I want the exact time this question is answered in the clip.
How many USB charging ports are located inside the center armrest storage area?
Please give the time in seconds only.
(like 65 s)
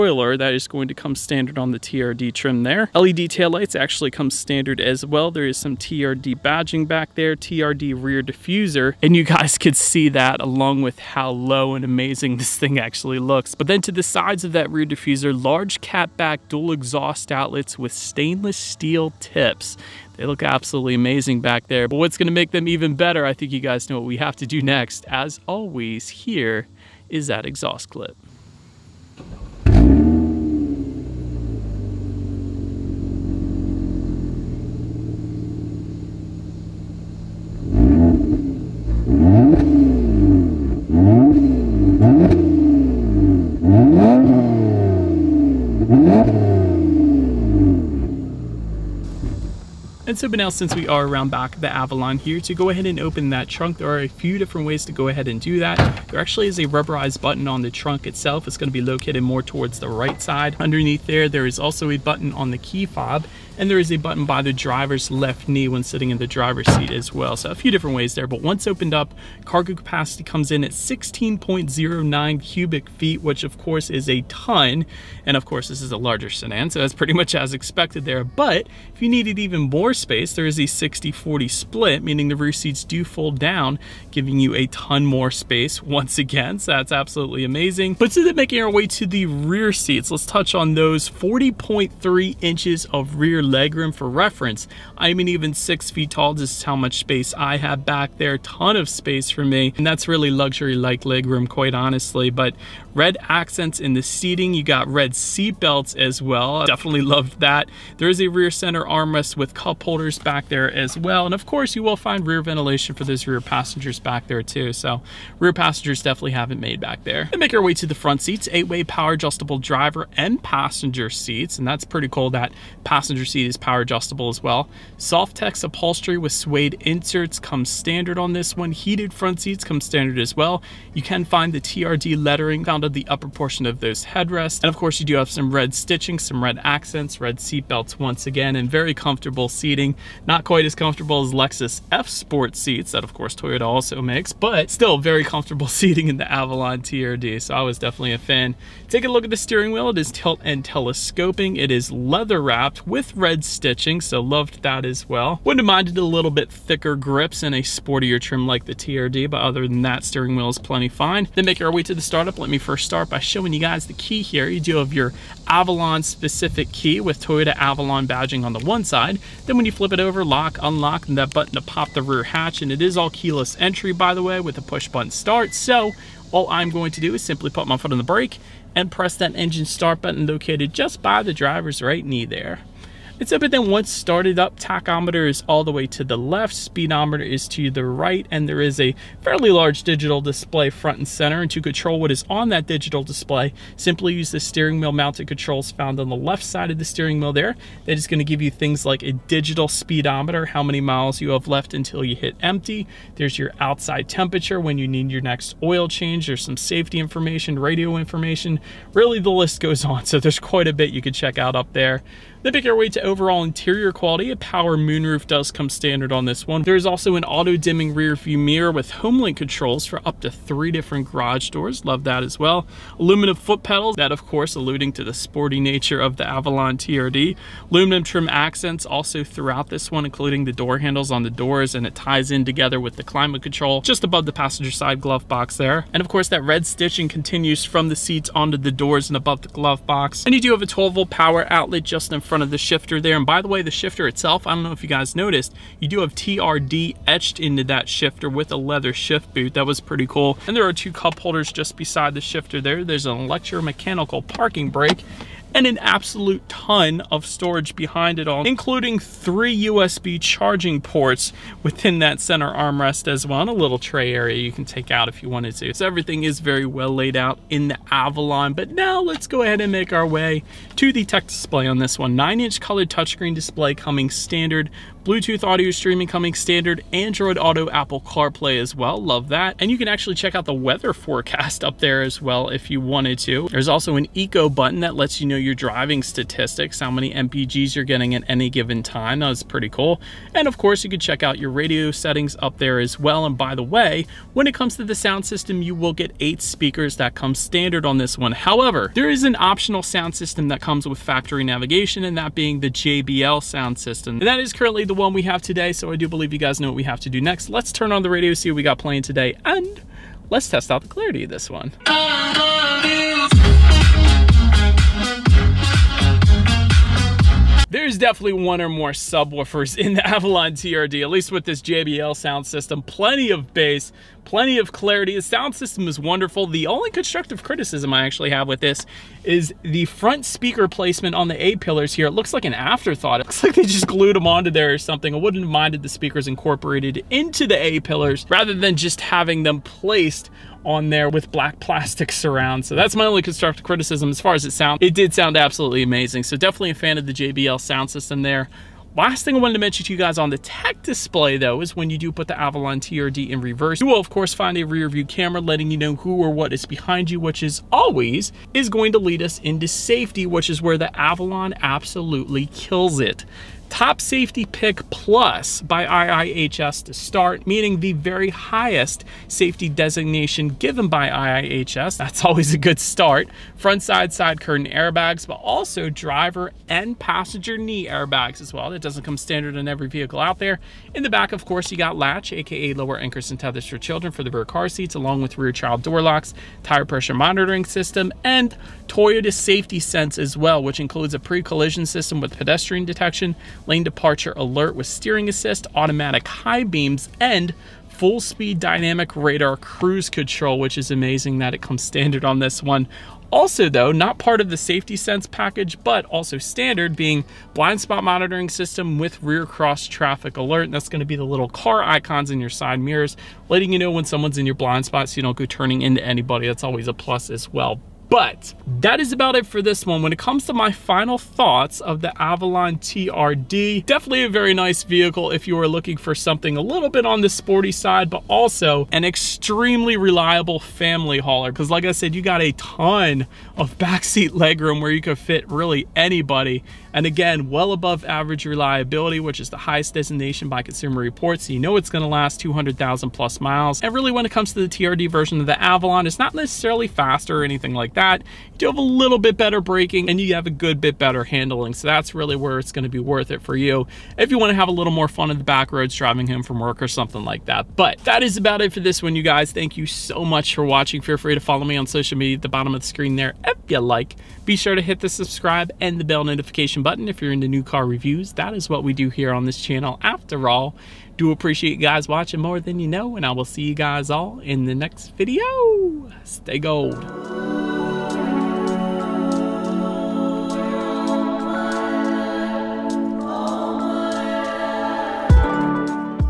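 258 s.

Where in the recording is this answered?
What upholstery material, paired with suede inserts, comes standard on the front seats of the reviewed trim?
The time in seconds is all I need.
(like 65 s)
124 s.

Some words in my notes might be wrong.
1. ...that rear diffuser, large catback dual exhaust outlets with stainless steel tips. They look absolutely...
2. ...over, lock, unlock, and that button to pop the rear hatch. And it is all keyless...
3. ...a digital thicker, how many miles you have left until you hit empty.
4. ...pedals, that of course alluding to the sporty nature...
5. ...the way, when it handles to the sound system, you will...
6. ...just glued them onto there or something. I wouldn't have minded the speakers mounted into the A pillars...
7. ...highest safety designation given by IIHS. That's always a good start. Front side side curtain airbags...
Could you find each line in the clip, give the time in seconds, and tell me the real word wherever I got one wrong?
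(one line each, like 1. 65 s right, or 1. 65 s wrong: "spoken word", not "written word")
1. 14 s right
2. 169 s right
3. 199 s wrong: "speedometer", not "thicker"
4. 223 s right
5. 293 s wrong: "comes", not "handles"
6. 333 s wrong: "incorporated", not "mounted"
7. 368 s right.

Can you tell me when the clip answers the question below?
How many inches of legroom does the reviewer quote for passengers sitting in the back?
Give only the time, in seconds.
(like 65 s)
91 s.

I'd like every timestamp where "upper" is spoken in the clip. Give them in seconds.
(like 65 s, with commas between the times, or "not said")
133 s.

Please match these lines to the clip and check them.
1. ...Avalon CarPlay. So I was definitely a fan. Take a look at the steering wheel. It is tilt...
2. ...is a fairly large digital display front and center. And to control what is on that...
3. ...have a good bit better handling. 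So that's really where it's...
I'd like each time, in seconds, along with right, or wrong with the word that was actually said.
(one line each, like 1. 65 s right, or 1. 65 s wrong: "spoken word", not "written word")
1. 146 s wrong: "TRD", not "CarPlay"
2. 188 s right
3. 450 s right.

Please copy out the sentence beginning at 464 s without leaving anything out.
Be sure to hit the subscribe and the bell notification button if you're into new car reviews.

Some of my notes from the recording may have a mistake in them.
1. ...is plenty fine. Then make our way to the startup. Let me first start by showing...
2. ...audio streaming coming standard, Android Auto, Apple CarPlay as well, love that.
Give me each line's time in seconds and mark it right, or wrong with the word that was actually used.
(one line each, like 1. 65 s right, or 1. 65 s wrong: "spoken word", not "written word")
1. 160 s right
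2. 275 s right.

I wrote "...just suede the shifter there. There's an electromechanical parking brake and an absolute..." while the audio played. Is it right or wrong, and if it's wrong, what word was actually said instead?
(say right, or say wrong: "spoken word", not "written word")
wrong: "beside", not "suede".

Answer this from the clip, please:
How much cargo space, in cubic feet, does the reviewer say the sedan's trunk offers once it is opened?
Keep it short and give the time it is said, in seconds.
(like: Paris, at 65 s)
16.09 cubic feet, at 70 s.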